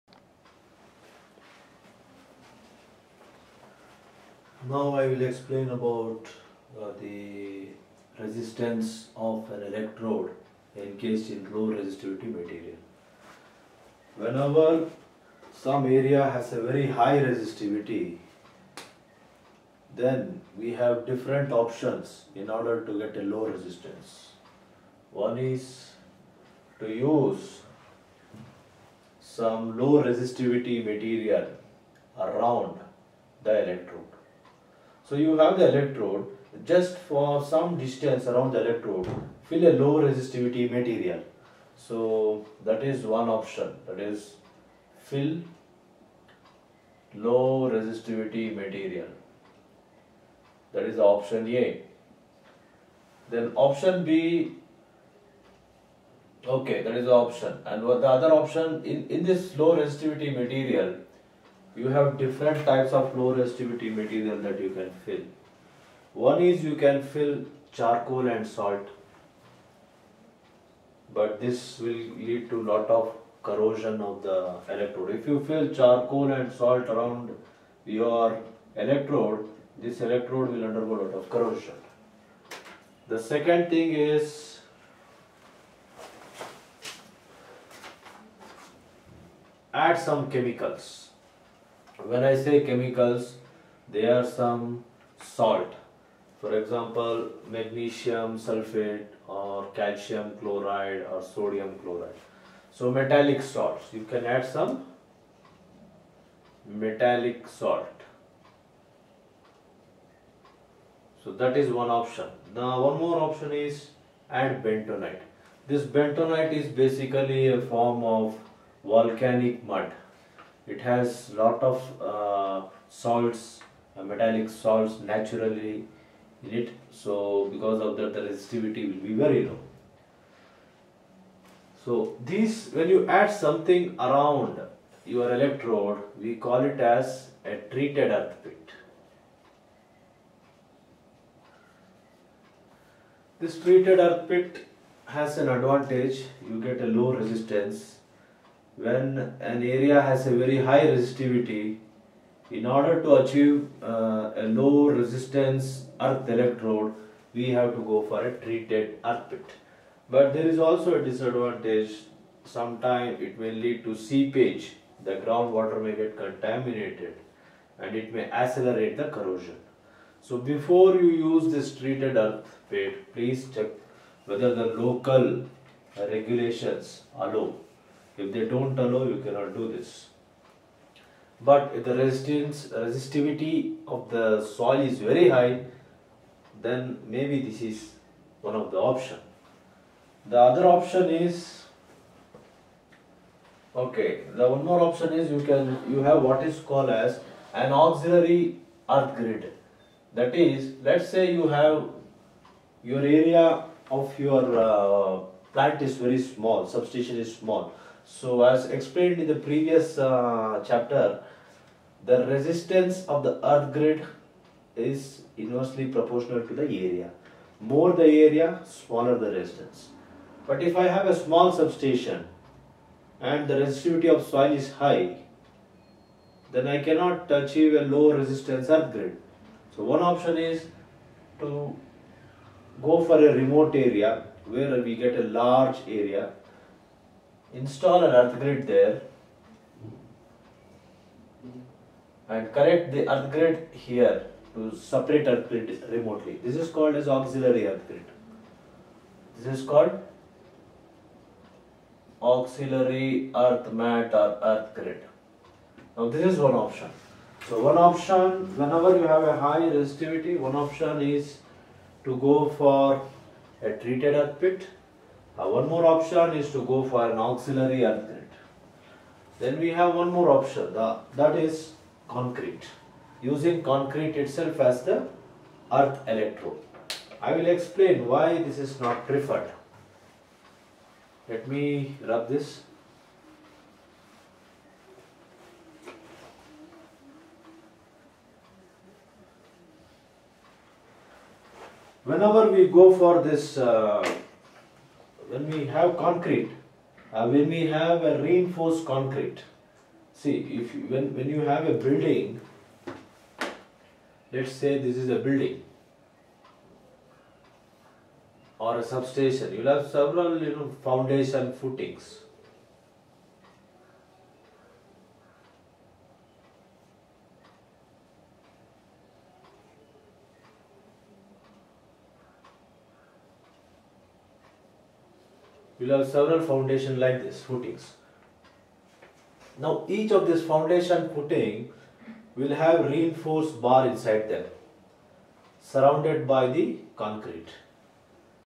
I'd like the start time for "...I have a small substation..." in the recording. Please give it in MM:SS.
03:40.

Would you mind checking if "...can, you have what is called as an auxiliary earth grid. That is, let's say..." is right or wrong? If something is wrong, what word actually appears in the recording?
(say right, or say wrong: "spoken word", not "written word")
right.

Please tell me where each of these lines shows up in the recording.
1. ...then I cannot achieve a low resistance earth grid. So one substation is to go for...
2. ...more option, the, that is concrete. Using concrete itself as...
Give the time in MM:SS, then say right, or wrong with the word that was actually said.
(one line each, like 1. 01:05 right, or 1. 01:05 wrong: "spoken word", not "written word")
1. 03:46 wrong: "option", not "substation"
2. 04:30 right.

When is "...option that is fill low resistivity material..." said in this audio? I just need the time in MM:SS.
00:43.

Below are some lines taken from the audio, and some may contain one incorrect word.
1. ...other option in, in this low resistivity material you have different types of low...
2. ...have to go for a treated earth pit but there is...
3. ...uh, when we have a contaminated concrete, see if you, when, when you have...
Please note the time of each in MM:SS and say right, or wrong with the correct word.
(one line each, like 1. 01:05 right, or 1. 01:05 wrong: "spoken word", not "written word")
1. 00:58 right
2. 02:37 right
3. 04:57 wrong: "reinforced", not "contaminated".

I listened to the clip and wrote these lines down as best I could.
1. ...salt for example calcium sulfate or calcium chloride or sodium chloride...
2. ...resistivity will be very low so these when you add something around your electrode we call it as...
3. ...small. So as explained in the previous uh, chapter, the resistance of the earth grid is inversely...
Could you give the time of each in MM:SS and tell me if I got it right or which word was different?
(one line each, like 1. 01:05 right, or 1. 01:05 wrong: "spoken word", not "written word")
1. 01:35 wrong: "magnesium", not "calcium"
2. 02:08 right
3. 03:27 right.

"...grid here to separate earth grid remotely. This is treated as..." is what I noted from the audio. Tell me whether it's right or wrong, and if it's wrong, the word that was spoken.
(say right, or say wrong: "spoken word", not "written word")
wrong: "called", not "treated".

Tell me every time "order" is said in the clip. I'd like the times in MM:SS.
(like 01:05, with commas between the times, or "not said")
00:22, 02:32.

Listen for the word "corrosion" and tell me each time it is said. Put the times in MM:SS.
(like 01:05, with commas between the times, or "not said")
01:13, 01:21, 02:49.